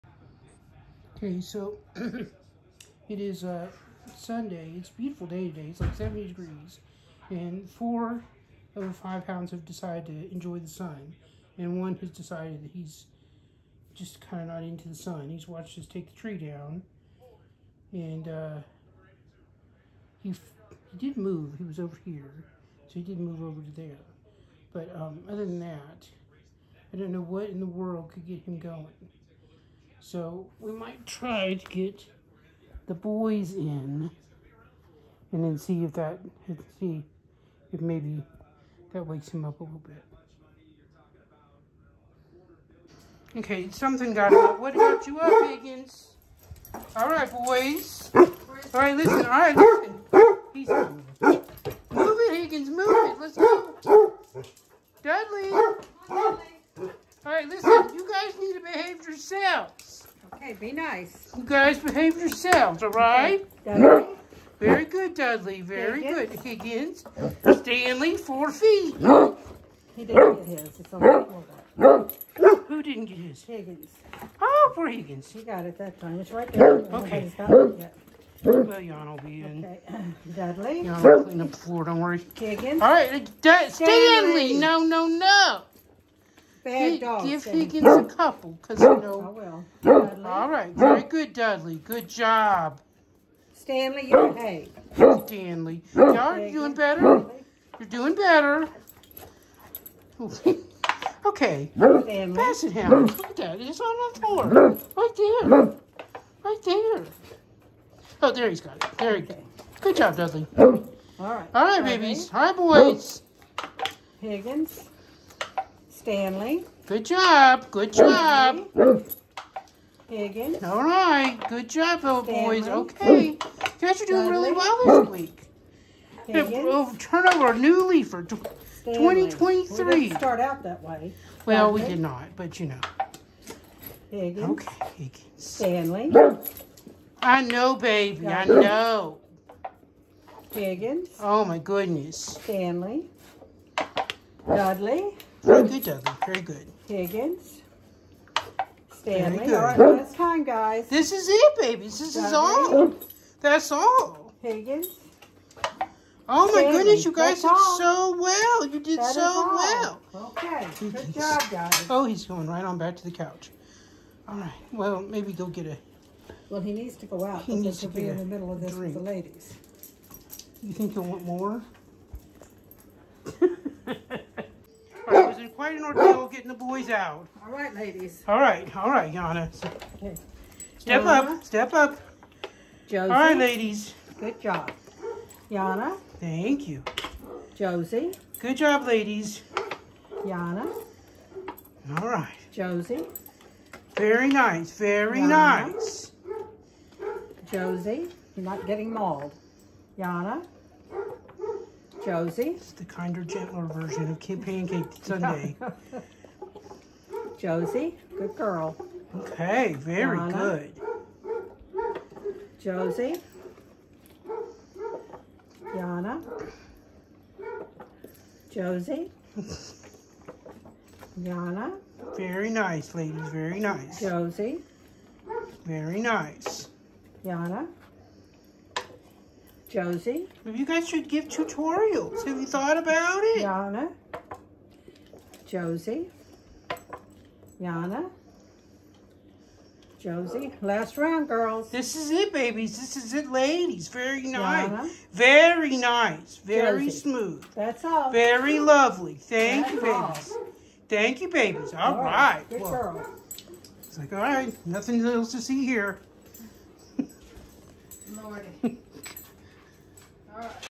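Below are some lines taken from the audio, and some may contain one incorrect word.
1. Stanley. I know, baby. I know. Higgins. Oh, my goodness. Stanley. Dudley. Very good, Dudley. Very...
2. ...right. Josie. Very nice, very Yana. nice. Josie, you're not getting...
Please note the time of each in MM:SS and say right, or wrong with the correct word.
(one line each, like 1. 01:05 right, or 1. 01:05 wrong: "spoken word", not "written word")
1. 02:15 right
2. 03:12 right.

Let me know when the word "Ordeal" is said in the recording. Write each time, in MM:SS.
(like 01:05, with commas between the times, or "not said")
02:55.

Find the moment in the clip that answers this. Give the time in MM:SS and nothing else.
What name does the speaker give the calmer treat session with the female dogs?
03:24.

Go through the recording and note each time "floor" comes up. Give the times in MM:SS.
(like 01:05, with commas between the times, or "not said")
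01:21, 01:44.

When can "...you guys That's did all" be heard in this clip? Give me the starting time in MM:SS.
02:37.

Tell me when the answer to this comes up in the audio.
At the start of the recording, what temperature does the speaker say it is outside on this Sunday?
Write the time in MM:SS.
00:05.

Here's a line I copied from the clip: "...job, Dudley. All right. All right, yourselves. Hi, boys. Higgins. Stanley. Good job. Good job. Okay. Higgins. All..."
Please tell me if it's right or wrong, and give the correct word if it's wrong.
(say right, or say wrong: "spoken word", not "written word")
wrong: "babies", not "yourselves".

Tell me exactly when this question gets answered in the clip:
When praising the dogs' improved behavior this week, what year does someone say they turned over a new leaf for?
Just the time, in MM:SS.
02:08.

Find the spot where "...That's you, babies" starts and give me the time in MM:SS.
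04:09.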